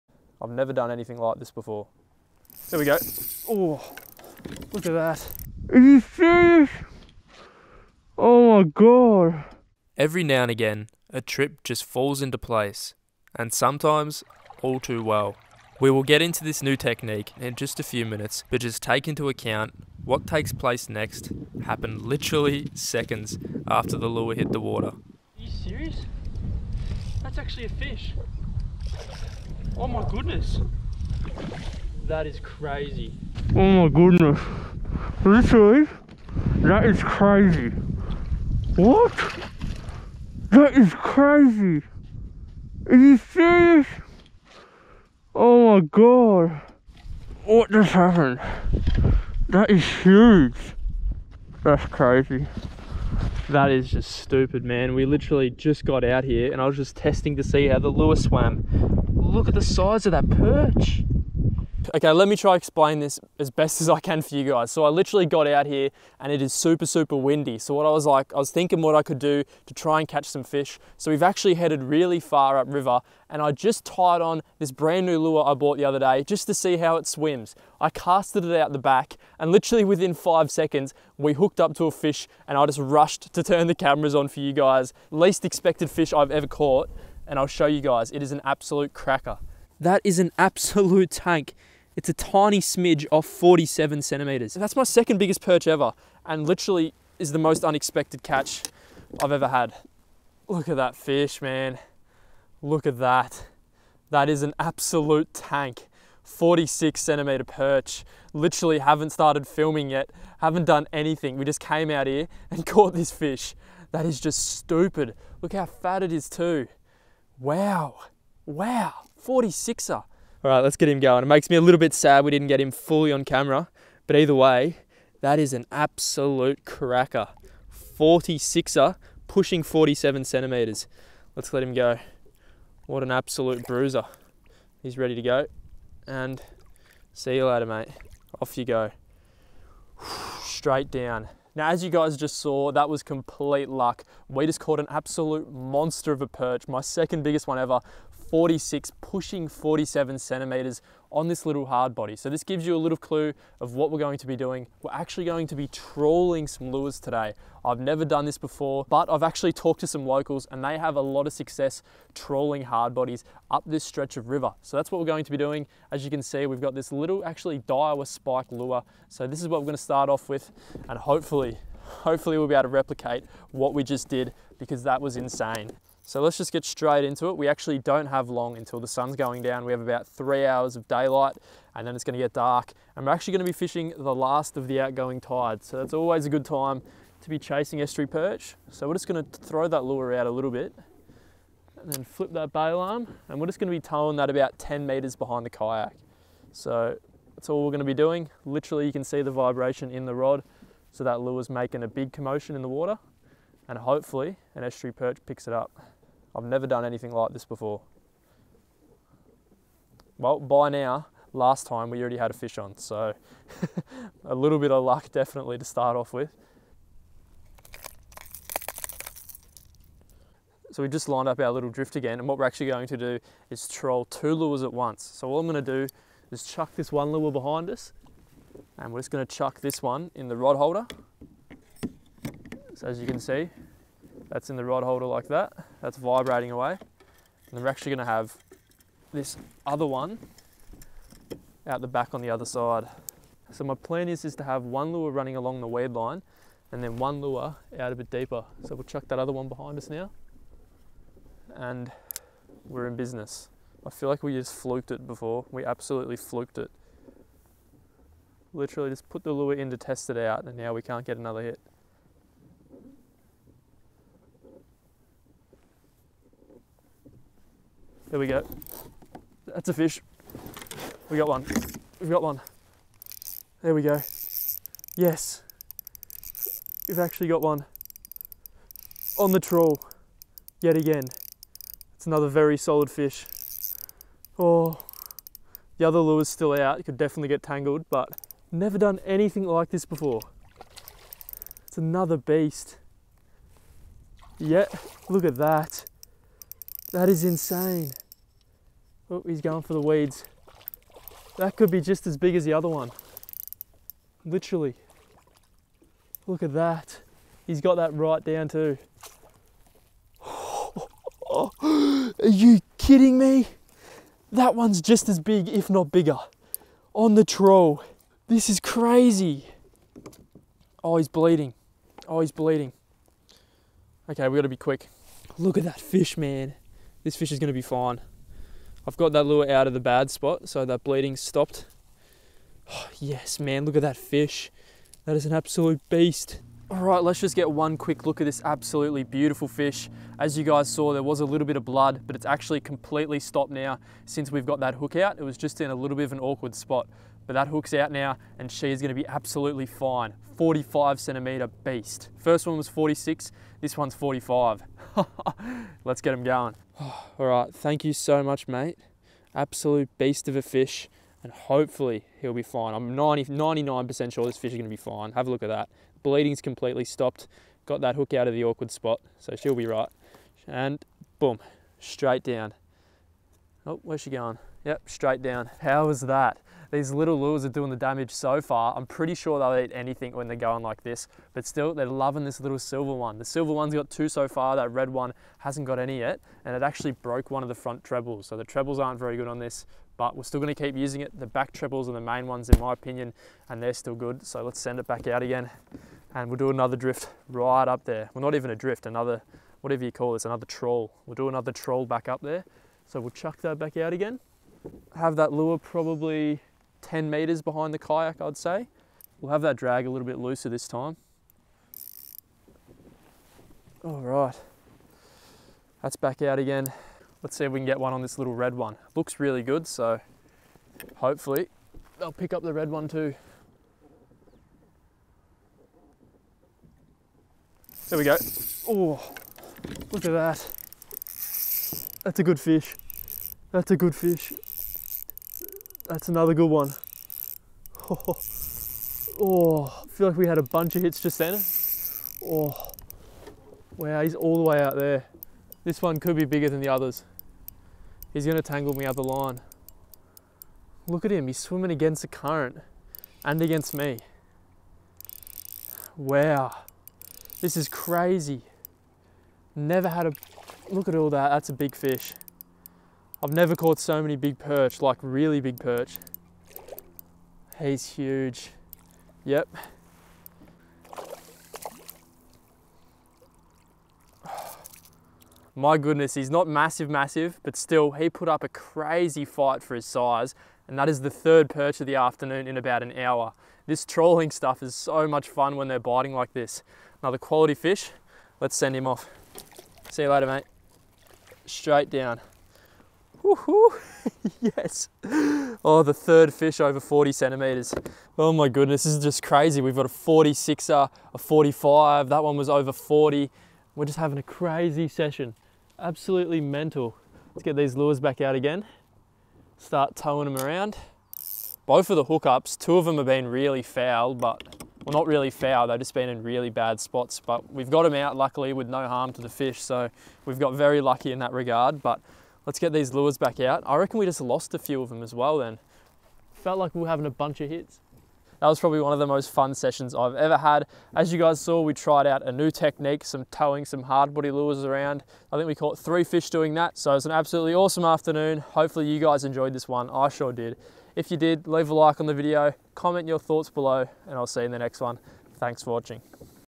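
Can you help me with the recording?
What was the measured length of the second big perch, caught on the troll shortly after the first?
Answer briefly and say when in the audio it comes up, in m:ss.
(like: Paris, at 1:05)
45 centimeters, at 5:50.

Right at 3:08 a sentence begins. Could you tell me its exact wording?
So we're just gonna throw that lure out a little bit and then flip that bail arm.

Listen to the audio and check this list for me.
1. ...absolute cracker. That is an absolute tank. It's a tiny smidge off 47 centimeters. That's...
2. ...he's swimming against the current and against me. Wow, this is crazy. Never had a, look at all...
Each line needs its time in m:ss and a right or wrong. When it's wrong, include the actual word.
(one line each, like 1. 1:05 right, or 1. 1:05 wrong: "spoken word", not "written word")
1. 1:28 right
2. 7:31 right.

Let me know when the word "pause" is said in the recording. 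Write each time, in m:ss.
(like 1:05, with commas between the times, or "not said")
not said.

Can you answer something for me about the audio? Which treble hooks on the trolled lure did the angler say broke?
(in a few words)
front trebles.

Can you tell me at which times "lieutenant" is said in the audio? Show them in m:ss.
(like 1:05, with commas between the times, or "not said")
not said.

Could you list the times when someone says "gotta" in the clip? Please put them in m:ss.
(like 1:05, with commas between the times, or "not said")
5:24.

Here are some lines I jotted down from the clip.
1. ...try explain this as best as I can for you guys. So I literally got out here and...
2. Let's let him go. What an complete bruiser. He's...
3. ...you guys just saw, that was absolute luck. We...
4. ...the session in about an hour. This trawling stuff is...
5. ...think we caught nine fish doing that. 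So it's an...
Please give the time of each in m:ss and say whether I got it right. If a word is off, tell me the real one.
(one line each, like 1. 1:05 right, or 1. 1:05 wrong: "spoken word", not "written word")
1. 1:02 right
2. 2:11 wrong: "absolute", not "complete"
3. 2:21 wrong: "complete", not "absolute"
4. 8:01 wrong: "afternoon", not "session"
5. 8:55 wrong: "three", not "nine".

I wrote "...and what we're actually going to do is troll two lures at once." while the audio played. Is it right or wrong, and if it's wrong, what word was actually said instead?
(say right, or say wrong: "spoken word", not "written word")
right.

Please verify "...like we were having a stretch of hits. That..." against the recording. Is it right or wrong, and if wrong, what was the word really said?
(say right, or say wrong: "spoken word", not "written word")
wrong: "bunch", not "stretch".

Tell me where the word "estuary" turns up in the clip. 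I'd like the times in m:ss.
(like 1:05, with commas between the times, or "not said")
3:07, 3:24.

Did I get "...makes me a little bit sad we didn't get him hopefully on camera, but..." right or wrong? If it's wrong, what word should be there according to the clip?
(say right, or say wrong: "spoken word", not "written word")
wrong: "fully", not "hopefully".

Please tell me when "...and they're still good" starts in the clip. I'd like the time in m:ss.
6:33.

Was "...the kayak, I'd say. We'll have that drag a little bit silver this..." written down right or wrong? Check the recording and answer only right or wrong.
wrong.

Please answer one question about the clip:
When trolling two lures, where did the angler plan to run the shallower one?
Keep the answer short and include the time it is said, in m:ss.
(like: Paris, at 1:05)
along the weed line, at 4:05.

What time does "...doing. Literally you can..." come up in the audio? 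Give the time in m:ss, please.
3:17.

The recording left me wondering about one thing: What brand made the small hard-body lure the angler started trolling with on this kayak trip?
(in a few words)
Daiwa.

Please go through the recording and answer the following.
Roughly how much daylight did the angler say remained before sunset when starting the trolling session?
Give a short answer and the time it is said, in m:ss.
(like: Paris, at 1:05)
3 hours, at 3:00.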